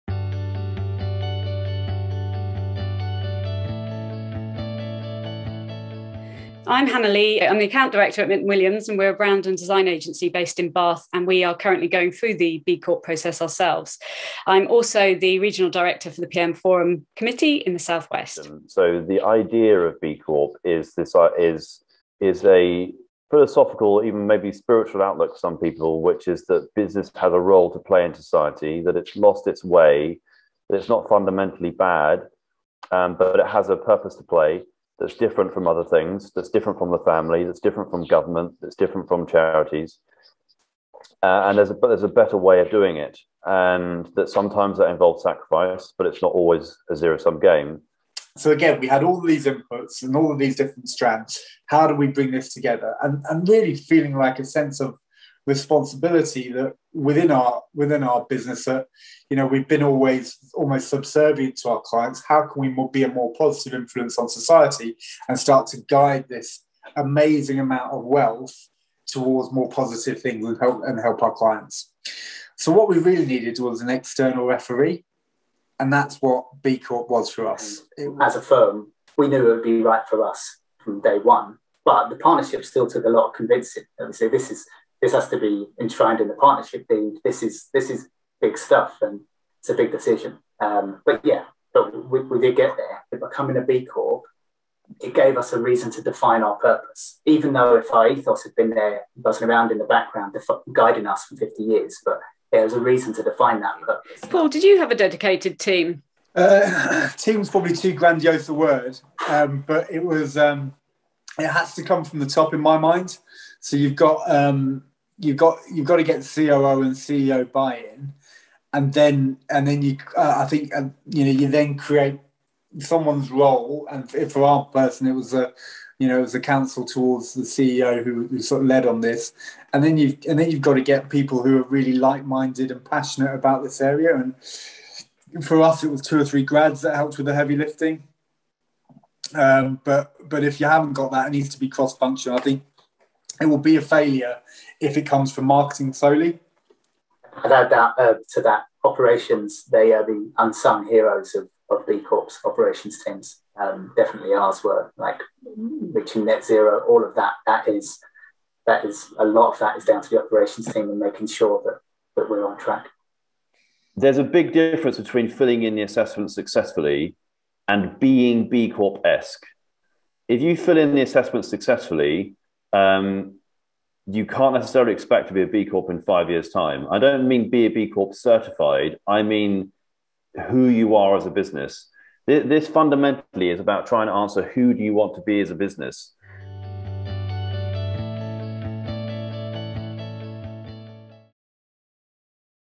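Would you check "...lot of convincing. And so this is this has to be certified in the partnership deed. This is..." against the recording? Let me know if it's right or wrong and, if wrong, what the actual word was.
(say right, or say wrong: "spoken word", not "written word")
wrong: "enshrined", not "certified".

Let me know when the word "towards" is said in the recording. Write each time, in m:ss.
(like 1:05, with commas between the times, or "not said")
1:09, 2:06.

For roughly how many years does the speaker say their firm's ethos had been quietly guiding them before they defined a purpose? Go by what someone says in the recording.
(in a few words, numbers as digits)
50.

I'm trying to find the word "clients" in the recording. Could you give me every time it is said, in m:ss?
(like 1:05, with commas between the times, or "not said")
1:01, 1:11.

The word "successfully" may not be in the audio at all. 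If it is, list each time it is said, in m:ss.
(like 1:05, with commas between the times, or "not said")
2:46, 2:51.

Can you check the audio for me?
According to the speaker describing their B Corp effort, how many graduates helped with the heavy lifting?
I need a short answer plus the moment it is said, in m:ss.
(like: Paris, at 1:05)
2 or 3, at 2:16.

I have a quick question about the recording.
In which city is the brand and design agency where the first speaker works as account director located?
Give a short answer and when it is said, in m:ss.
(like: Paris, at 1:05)
Bath, at 0:10.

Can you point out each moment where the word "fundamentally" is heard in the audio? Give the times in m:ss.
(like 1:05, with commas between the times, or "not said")
0:31, 3:02.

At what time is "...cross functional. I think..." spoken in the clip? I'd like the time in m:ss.
2:21.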